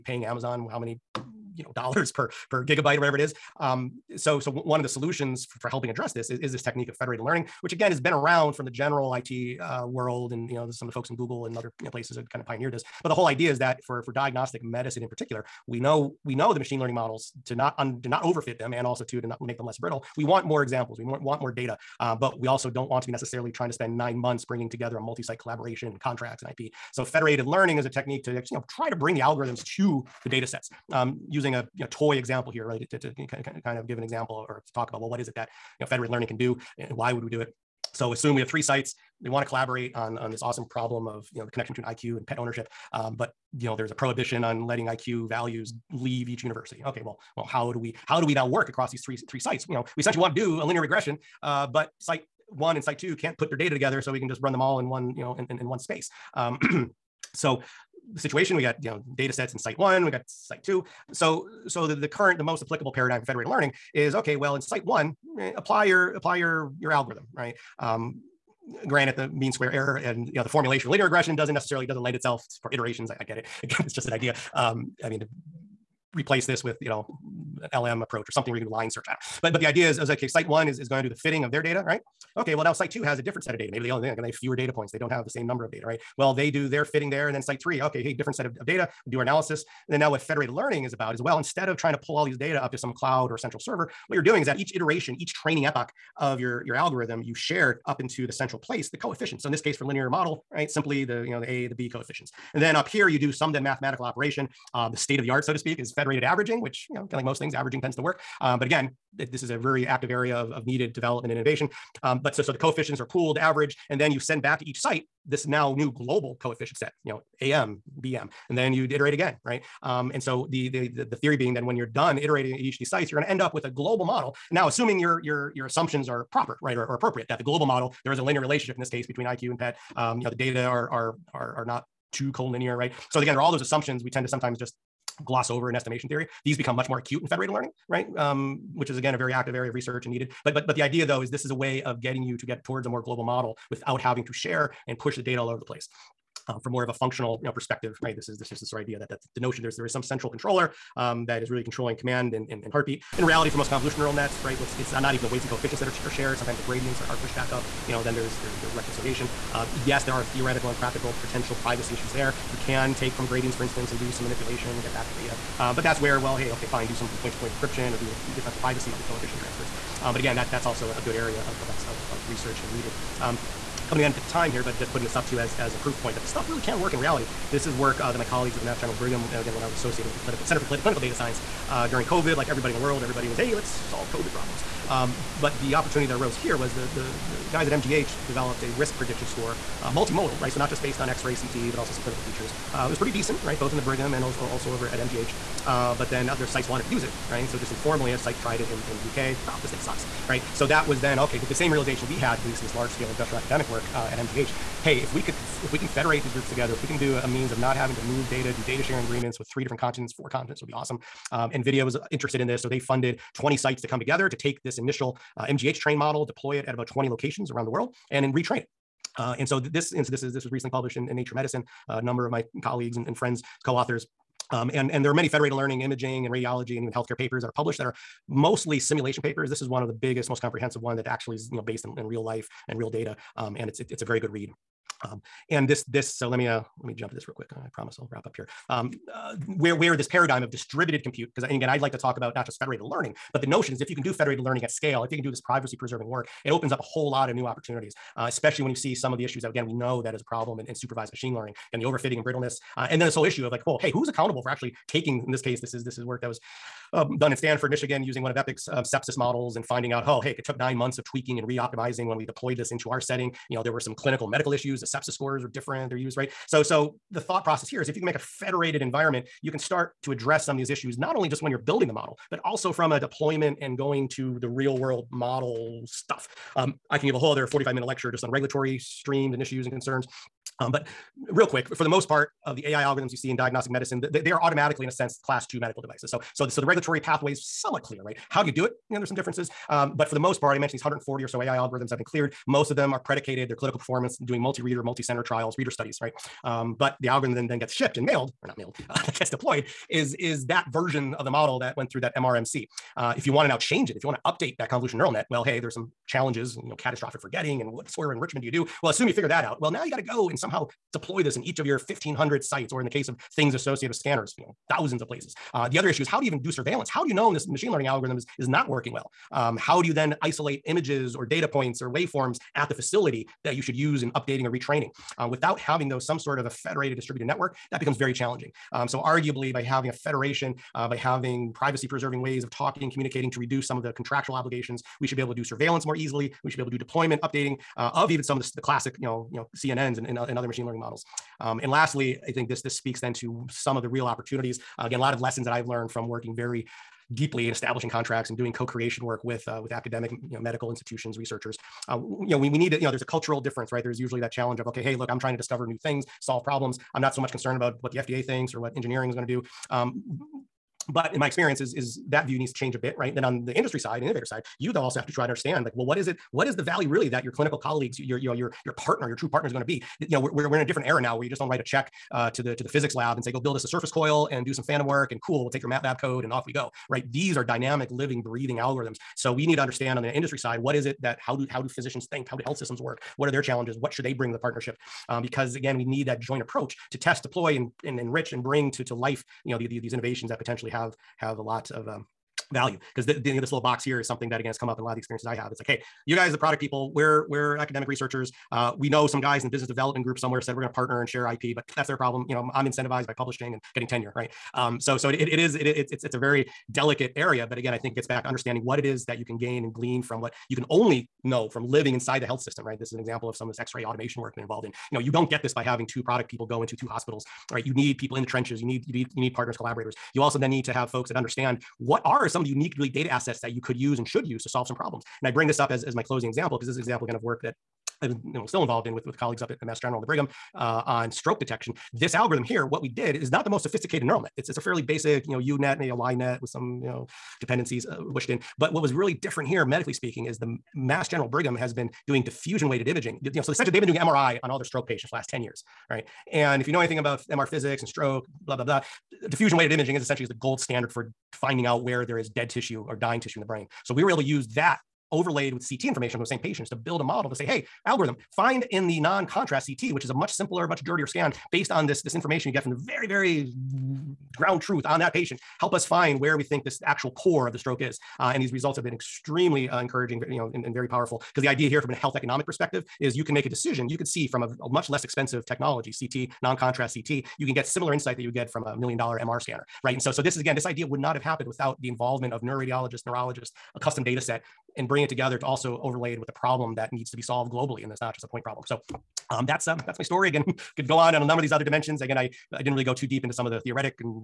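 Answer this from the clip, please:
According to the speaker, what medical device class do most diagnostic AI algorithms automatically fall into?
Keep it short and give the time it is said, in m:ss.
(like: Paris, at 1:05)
class 2, at 4:45.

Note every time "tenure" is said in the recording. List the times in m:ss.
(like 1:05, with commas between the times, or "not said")
6:43.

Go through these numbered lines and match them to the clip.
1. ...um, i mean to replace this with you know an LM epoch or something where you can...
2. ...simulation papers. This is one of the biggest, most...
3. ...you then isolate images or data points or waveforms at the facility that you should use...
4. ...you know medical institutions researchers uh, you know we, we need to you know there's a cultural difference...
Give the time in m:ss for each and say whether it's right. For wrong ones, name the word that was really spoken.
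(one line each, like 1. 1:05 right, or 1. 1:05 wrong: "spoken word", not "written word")
1. 1:14 wrong: "approach", not "epoch"
2. 3:48 right
3. 5:19 right
4. 5:50 right.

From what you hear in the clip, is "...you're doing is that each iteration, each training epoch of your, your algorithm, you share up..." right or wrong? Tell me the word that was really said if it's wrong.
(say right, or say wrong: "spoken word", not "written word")
right.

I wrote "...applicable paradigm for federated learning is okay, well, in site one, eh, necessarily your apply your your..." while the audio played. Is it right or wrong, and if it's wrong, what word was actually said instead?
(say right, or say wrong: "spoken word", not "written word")
wrong: "apply", not "necessarily".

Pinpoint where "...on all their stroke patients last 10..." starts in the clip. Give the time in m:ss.
7:24.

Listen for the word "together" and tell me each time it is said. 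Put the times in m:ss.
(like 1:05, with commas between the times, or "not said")
0:24, 0:53, 3:26, 3:33, 8:05.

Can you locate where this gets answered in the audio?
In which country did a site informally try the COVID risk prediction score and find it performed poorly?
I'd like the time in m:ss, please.
3:19.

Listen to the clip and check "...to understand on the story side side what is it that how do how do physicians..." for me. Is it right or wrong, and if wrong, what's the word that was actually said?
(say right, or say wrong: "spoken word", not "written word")
wrong: "industry", not "story".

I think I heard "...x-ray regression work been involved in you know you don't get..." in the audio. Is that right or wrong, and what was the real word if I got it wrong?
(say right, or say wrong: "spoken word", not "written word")
wrong: "automation", not "regression".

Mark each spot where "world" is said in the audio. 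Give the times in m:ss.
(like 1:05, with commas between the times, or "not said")
0:09, 3:02, 3:37, 4:34.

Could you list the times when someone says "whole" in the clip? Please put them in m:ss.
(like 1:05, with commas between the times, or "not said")
0:13, 4:06, 4:13, 4:37.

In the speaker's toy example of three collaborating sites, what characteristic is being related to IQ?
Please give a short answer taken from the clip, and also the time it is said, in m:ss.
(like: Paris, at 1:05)
pet ownership, at 0:42.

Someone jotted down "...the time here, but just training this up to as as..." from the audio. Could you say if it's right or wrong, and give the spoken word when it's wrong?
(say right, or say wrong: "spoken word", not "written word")
wrong: "putting", not "training".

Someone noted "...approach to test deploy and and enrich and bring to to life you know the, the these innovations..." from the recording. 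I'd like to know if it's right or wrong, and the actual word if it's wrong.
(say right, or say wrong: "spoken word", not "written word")
right.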